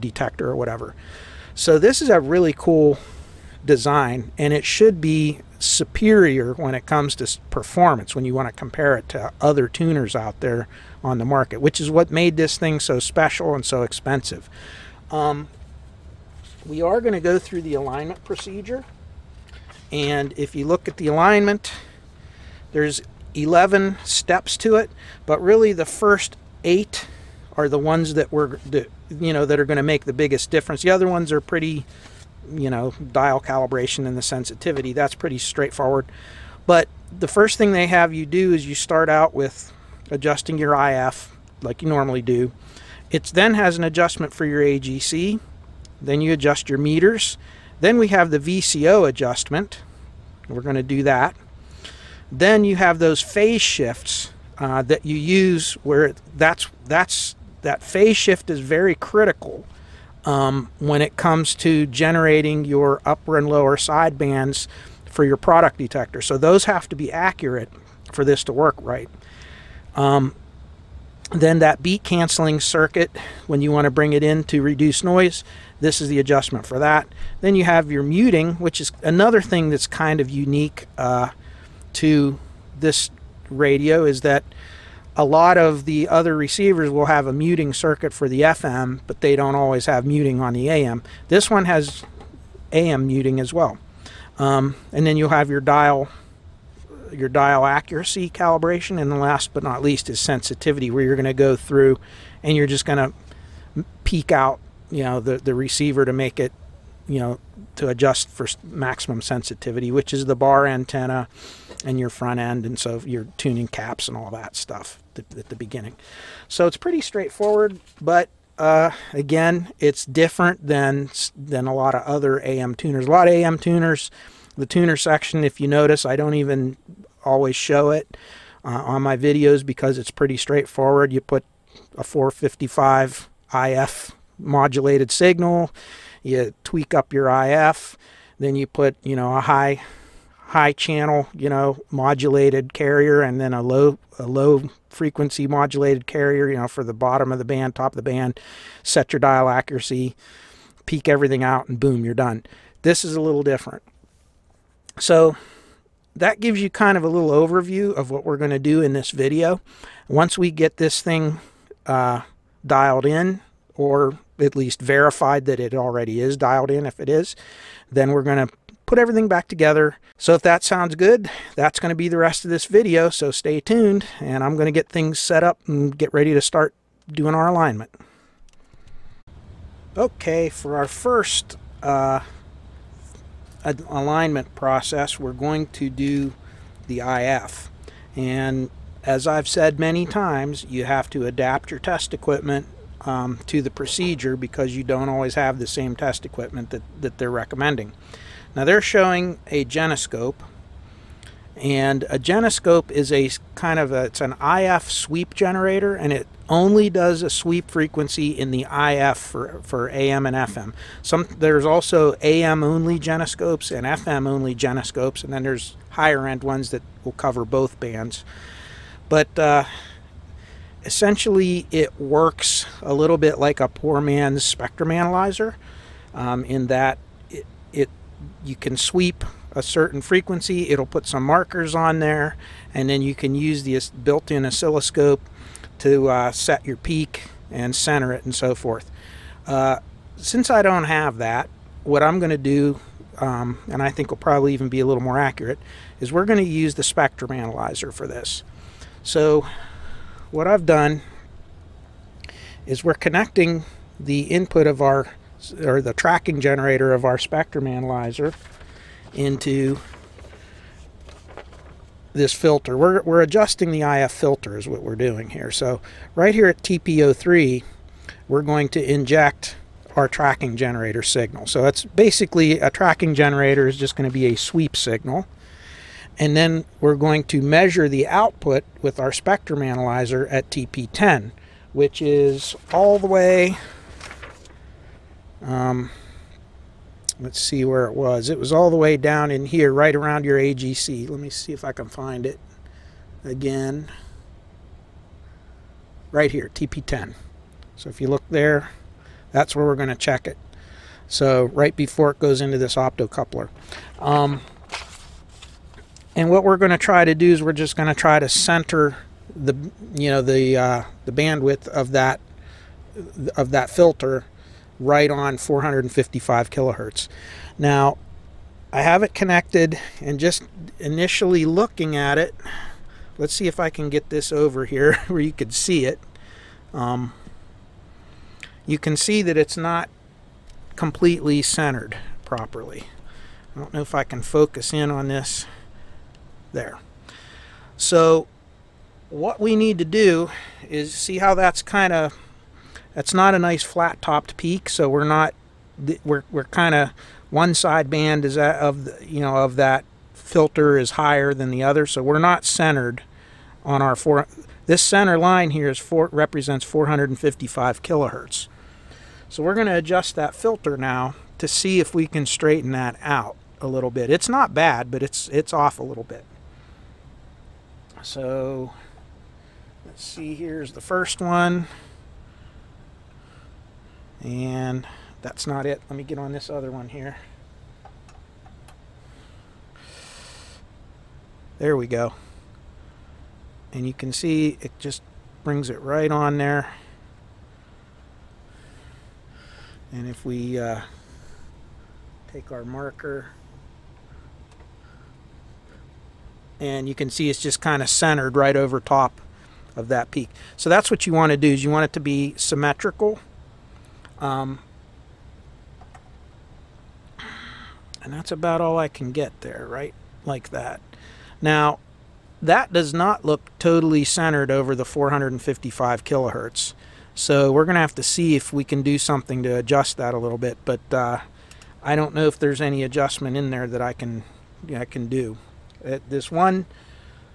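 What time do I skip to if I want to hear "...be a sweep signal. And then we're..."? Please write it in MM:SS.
04:34.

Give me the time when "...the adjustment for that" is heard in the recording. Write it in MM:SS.
01:16.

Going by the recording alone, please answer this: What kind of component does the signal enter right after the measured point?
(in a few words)
optocoupler.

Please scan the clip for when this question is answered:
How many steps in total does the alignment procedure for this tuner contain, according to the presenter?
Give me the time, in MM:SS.
00:23.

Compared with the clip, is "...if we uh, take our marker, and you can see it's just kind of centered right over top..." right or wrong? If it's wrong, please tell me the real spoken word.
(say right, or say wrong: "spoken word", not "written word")
right.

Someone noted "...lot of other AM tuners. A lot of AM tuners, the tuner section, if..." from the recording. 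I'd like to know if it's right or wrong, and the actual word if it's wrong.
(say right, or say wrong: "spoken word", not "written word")
right.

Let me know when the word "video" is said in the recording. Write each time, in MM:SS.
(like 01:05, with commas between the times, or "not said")
02:09, 02:39, 02:52.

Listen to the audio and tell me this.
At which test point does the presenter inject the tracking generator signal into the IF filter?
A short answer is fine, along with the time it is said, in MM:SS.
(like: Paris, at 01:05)
TPO3, at 04:26.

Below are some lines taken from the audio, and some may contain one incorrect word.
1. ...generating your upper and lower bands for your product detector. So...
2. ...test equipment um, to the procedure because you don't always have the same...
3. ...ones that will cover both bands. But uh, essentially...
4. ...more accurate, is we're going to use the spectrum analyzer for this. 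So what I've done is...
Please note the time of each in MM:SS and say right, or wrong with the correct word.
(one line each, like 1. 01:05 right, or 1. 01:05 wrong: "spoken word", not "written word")
1. 01:01 wrong: "sidebands", not "bands"
2. 03:11 right
3. 03:36 right
4. 04:05 right.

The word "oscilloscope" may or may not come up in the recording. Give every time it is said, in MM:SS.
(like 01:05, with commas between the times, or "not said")
03:54.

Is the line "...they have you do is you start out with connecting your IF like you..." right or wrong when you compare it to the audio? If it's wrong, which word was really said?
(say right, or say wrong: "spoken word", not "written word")
wrong: "adjusting", not "connecting".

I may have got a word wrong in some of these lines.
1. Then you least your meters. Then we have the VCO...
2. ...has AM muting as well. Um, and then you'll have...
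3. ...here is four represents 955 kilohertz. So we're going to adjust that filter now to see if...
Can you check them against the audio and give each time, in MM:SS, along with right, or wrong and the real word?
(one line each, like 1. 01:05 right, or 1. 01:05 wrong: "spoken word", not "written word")
1. 00:46 wrong: "adjust", not "least"
2. 01:31 right
3. 05:55 wrong: "455", not "955".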